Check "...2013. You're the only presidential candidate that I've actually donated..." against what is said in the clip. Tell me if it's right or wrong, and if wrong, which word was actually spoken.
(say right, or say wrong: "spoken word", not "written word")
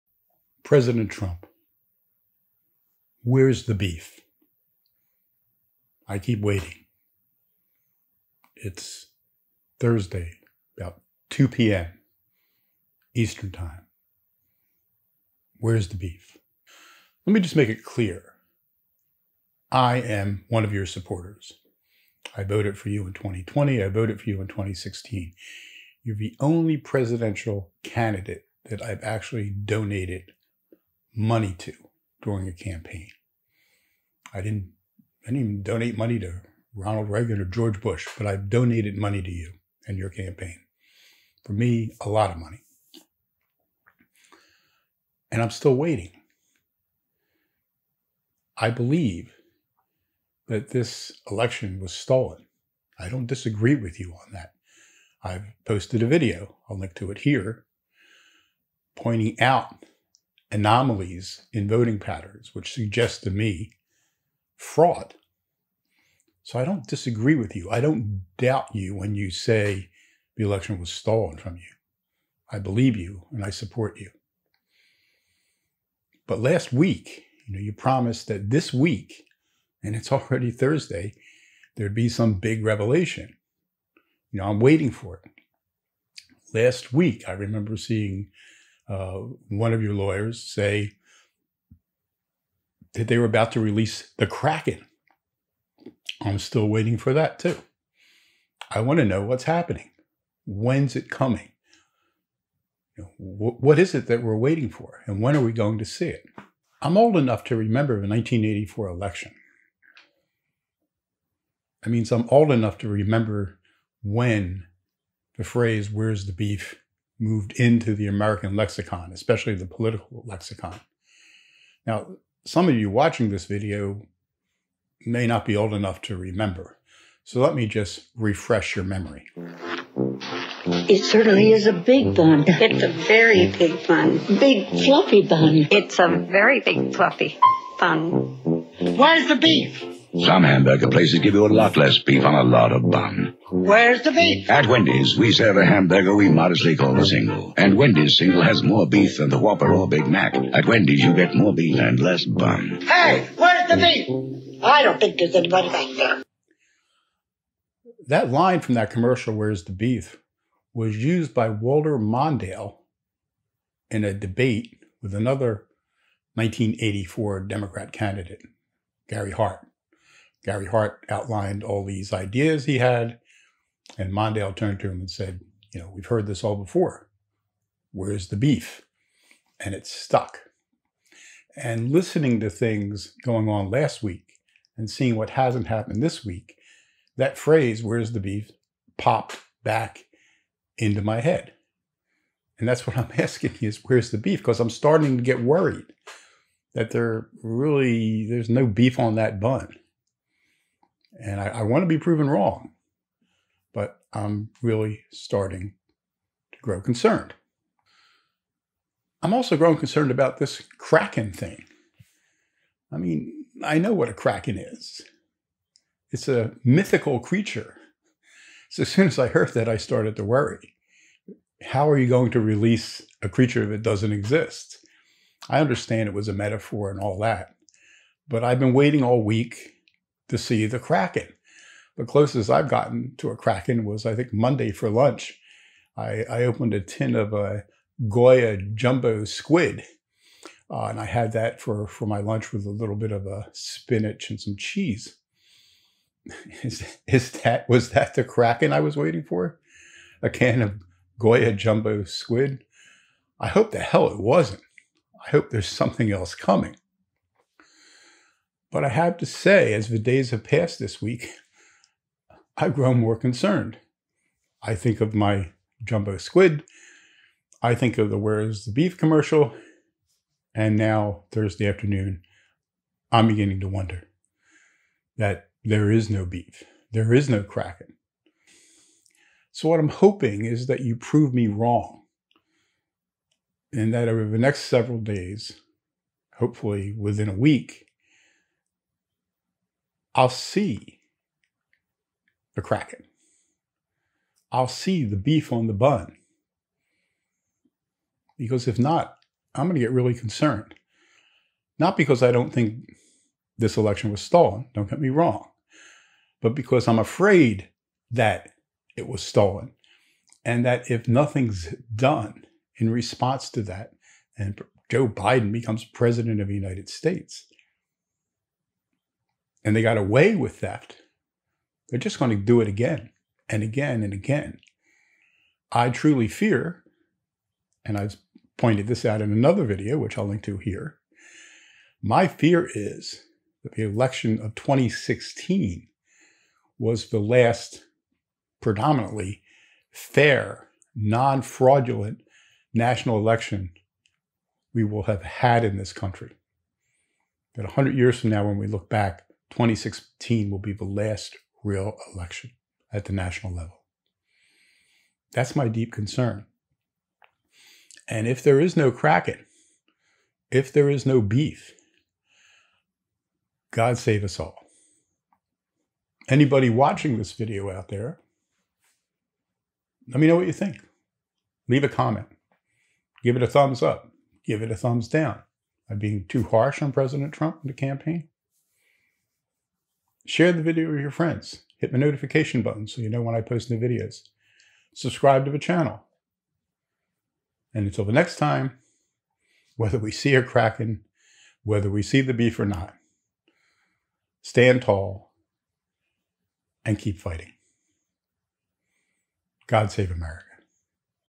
wrong: "2016", not "2013".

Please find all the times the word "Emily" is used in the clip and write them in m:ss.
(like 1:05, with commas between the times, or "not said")
not said.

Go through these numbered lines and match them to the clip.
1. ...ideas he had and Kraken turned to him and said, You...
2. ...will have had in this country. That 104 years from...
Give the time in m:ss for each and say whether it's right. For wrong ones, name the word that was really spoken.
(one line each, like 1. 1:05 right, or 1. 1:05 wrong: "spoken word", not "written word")
1. 2:52 wrong: "Mondale", not "Kraken"
2. 5:44 wrong: "100", not "104".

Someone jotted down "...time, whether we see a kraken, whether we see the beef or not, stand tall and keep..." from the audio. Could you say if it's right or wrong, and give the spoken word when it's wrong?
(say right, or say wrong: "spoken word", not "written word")
right.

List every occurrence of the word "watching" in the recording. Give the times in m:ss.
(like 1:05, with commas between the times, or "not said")
2:02, 6:06.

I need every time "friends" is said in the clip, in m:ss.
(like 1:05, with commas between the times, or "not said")
6:21.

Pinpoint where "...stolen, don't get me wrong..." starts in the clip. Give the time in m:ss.
5:04.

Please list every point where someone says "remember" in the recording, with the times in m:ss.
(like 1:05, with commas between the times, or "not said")
1:27, 1:47, 1:52, 2:06.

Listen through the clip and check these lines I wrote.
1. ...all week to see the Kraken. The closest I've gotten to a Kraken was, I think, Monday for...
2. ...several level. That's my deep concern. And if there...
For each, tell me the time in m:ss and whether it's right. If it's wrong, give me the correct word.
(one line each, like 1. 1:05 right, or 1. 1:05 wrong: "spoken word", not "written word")
1. 3:49 right
2. 5:53 wrong: "national", not "several".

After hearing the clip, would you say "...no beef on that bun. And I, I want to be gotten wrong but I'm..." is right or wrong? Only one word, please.
wrong.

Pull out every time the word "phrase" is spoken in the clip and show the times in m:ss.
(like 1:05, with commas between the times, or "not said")
1:55, 3:07.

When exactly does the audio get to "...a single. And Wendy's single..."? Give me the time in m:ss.
2:26.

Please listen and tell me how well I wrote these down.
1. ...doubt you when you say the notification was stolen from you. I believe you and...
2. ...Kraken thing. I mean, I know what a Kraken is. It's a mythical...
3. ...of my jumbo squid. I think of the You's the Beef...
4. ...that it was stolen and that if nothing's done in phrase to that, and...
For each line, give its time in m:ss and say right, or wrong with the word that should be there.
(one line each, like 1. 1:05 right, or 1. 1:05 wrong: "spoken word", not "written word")
1. 1:08 wrong: "election", not "notification"
2. 3:30 right
3. 4:25 wrong: "Where", not "You"
4. 5:08 wrong: "response", not "phrase".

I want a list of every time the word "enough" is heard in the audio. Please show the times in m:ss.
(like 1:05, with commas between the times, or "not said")
1:47, 1:52, 2:05.